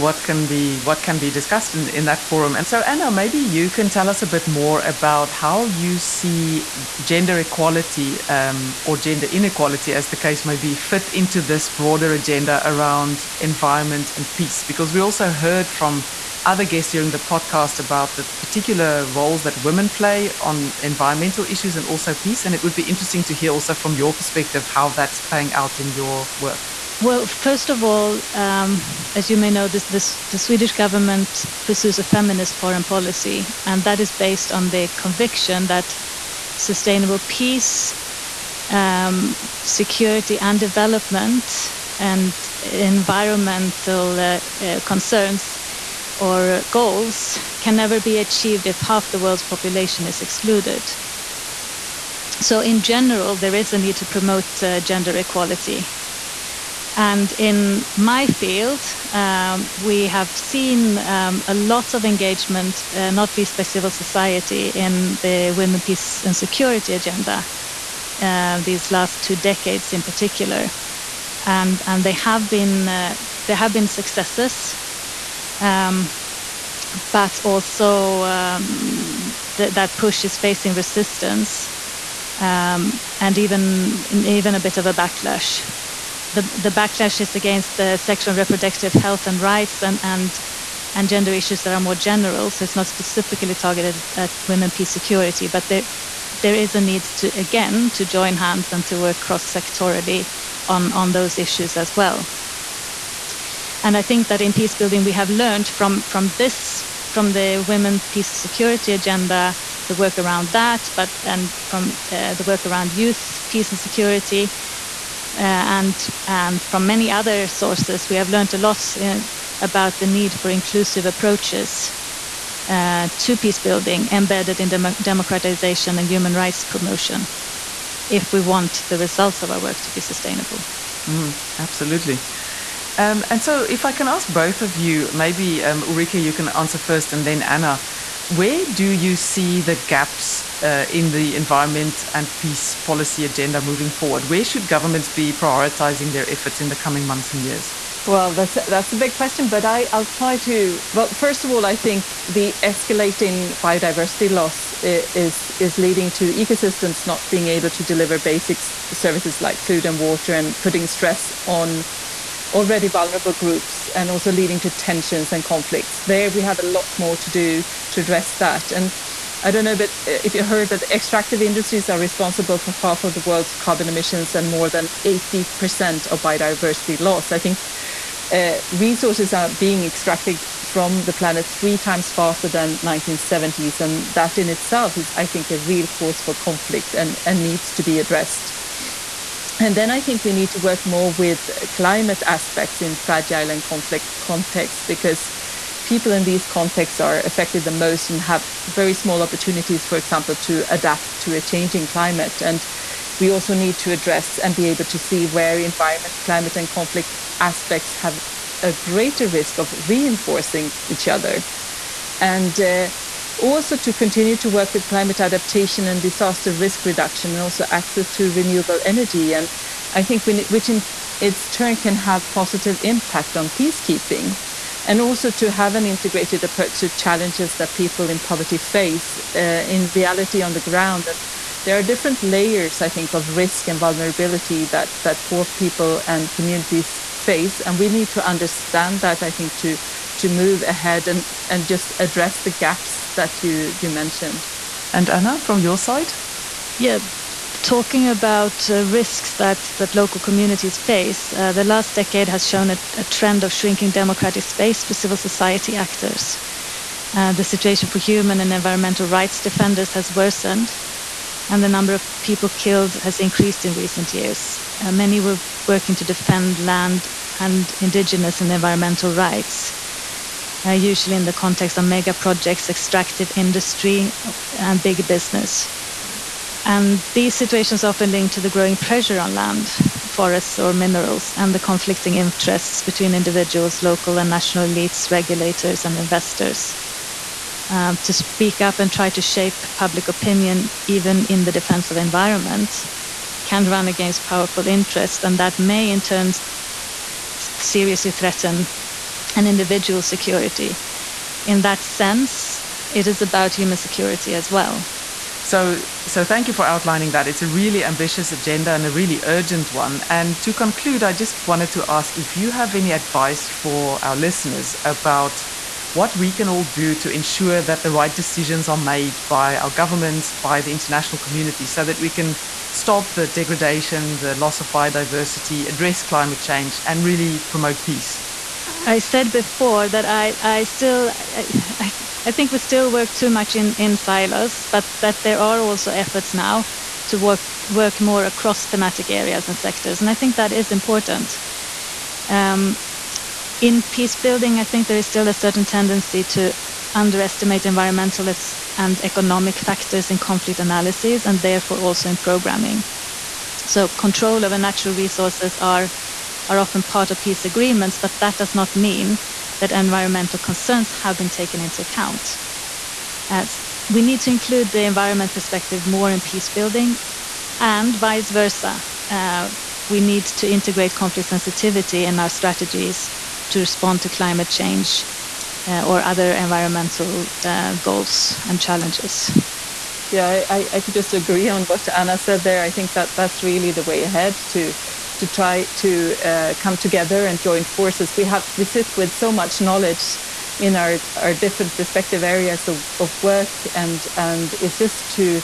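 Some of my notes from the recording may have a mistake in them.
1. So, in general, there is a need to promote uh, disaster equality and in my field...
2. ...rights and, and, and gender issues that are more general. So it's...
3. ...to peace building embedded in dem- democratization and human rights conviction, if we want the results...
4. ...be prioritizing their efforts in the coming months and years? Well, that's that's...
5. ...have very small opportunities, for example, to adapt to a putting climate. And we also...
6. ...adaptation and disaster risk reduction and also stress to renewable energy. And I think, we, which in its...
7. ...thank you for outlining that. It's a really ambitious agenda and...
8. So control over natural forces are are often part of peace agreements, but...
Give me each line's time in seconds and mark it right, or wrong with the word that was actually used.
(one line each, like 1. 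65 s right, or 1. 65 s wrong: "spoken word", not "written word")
1. 52 s wrong: "gender", not "disaster"
2. 89 s right
3. 123 s wrong: "promotion", not "conviction"
4. 145 s right
5. 198 s wrong: "changing", not "putting"
6. 215 s wrong: "access", not "stress"
7. 306 s right
8. 353 s wrong: "resources", not "forces".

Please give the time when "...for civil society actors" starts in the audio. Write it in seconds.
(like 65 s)
254 s.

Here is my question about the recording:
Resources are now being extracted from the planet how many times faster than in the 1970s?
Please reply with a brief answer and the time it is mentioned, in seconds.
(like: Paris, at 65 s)
3 times, at 181 s.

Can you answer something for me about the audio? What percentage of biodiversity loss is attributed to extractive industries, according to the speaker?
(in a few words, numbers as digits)
More than 80%.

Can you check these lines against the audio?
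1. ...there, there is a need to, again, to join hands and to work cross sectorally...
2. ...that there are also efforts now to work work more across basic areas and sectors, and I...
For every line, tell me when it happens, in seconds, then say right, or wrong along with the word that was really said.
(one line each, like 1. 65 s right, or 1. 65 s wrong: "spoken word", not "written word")
1. 95 s right
2. 335 s wrong: "thematic", not "basic".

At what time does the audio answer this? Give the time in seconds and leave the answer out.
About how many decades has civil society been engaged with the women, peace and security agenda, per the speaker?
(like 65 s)
69 s.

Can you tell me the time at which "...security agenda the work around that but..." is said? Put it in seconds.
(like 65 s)
108 s.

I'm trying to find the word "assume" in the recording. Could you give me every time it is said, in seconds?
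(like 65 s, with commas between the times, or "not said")
not said.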